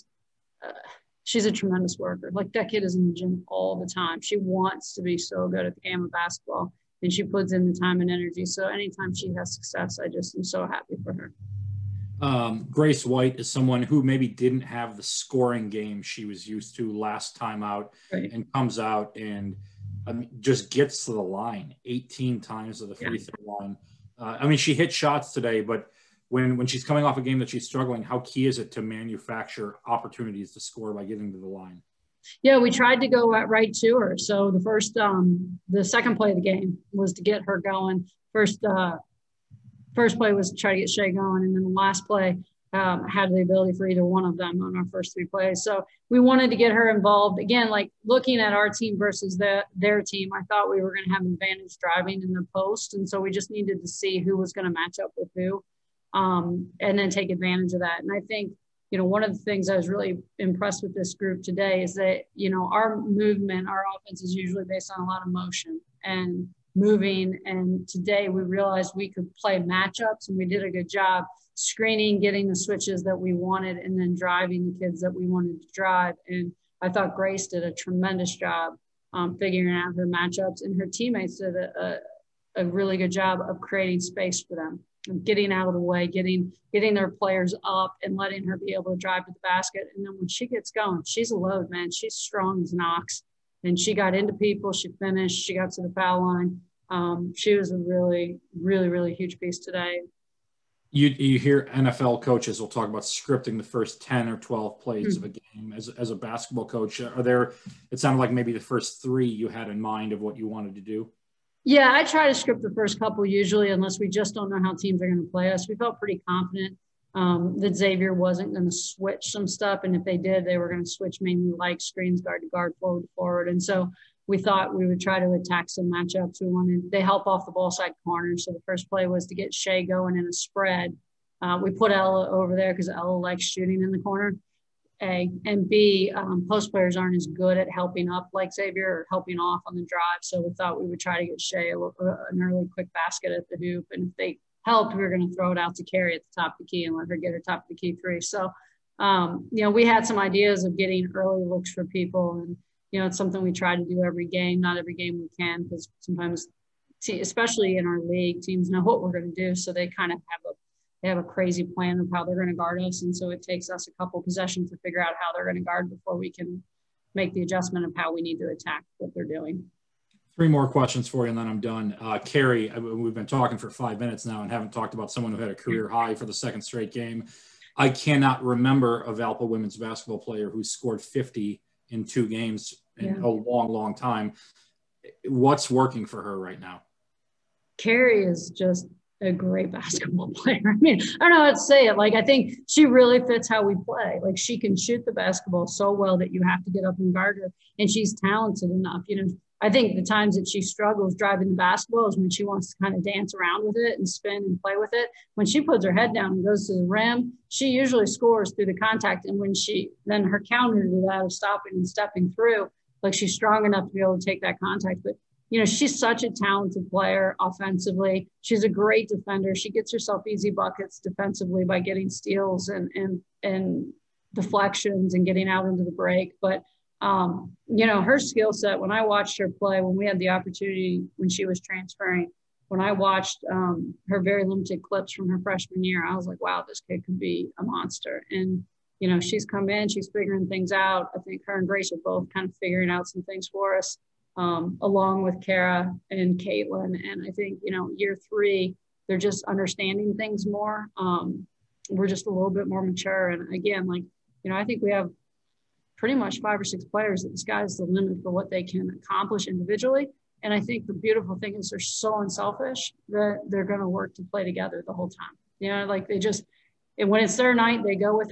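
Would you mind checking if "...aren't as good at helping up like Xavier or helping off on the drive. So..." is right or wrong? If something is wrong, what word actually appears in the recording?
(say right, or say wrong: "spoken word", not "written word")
right.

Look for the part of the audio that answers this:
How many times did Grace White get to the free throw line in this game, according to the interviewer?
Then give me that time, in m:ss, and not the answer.
0:21.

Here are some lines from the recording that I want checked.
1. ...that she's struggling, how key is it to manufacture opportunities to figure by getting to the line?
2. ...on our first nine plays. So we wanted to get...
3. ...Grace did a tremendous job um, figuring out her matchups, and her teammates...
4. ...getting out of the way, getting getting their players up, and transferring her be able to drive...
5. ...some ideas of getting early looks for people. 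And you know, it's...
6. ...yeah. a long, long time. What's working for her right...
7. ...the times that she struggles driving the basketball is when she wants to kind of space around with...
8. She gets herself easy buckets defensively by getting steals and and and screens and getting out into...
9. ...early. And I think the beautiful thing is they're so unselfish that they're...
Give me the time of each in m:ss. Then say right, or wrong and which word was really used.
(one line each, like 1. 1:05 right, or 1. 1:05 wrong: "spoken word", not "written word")
1. 0:27 wrong: "score", not "figure"
2. 0:44 wrong: "three", not "nine"
3. 1:17 right
4. 1:25 wrong: "letting", not "transferring"
5. 2:30 right
6. 3:03 right
7. 3:19 wrong: "dance", not "space"
8. 3:39 wrong: "deflections", not "screens"
9. 4:19 wrong: "individually", not "early".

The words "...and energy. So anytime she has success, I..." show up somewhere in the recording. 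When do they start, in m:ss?
0:08.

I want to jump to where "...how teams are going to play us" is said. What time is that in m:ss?
1:54.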